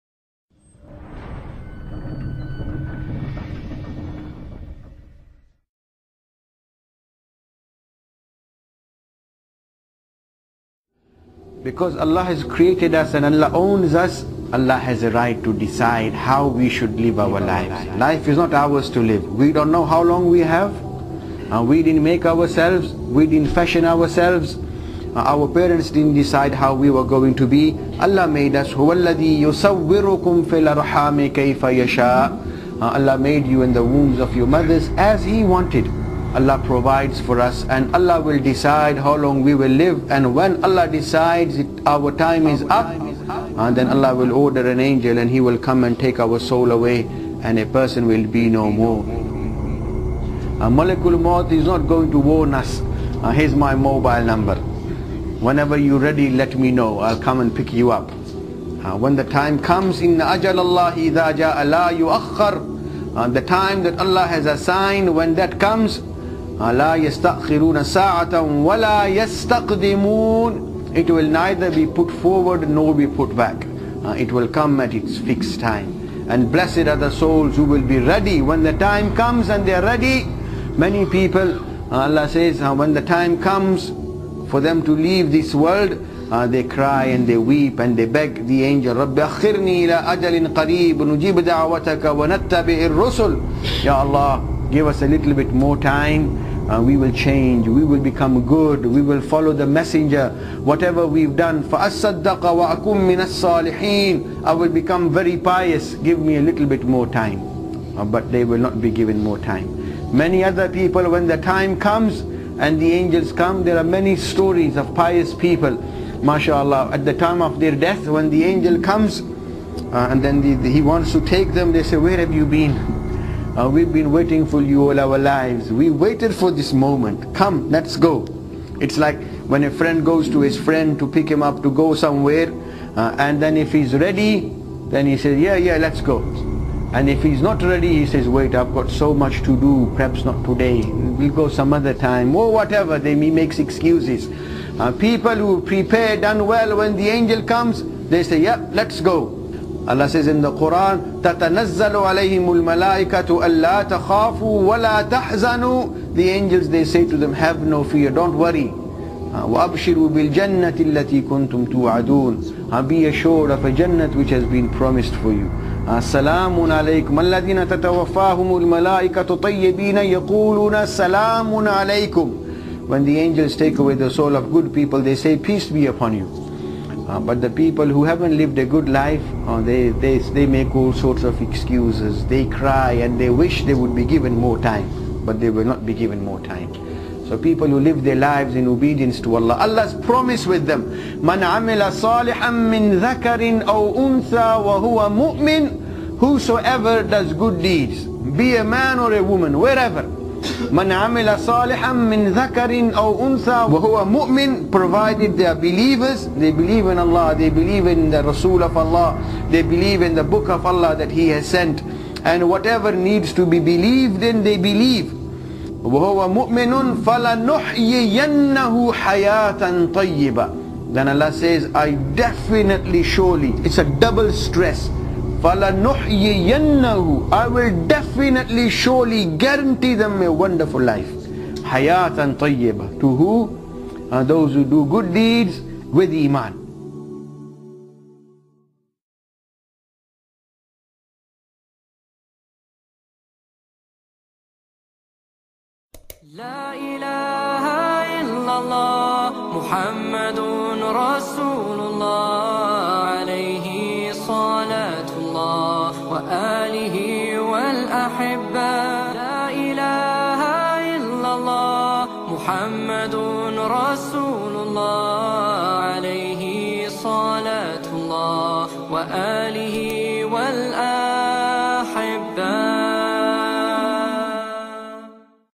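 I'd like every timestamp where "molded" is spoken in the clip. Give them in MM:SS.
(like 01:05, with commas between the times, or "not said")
not said.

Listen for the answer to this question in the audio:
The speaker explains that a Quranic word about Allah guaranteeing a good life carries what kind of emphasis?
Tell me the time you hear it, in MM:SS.
03:43.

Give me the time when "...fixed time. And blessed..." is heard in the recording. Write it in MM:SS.
01:15.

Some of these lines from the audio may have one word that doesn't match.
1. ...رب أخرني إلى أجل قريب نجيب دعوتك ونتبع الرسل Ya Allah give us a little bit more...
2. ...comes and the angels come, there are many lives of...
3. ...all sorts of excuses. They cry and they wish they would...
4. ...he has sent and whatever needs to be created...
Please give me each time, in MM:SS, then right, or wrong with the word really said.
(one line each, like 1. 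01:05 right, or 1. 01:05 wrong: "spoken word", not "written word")
1. 01:28 right
2. 01:51 wrong: "stories", not "lives"
3. 03:00 right
4. 03:31 wrong: "believed", not "created".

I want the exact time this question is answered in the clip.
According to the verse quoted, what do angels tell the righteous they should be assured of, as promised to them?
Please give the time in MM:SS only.
02:43.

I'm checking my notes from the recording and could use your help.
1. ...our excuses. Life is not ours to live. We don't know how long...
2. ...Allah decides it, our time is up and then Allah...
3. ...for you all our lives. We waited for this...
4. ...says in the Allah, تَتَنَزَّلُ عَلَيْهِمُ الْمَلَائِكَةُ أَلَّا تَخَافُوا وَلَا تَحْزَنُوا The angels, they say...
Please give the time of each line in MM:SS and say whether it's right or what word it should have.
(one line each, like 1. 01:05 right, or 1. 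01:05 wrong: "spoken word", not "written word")
1. 00:17 wrong: "lives", not "excuses"
2. 00:40 right
3. 02:04 right
4. 02:30 wrong: "Quran", not "Allah".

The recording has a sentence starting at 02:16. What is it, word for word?
And if he's not ready, he says, wait, I've got so much to do, perhaps not today.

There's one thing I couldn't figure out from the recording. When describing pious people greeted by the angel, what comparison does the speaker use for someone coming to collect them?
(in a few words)
a friend.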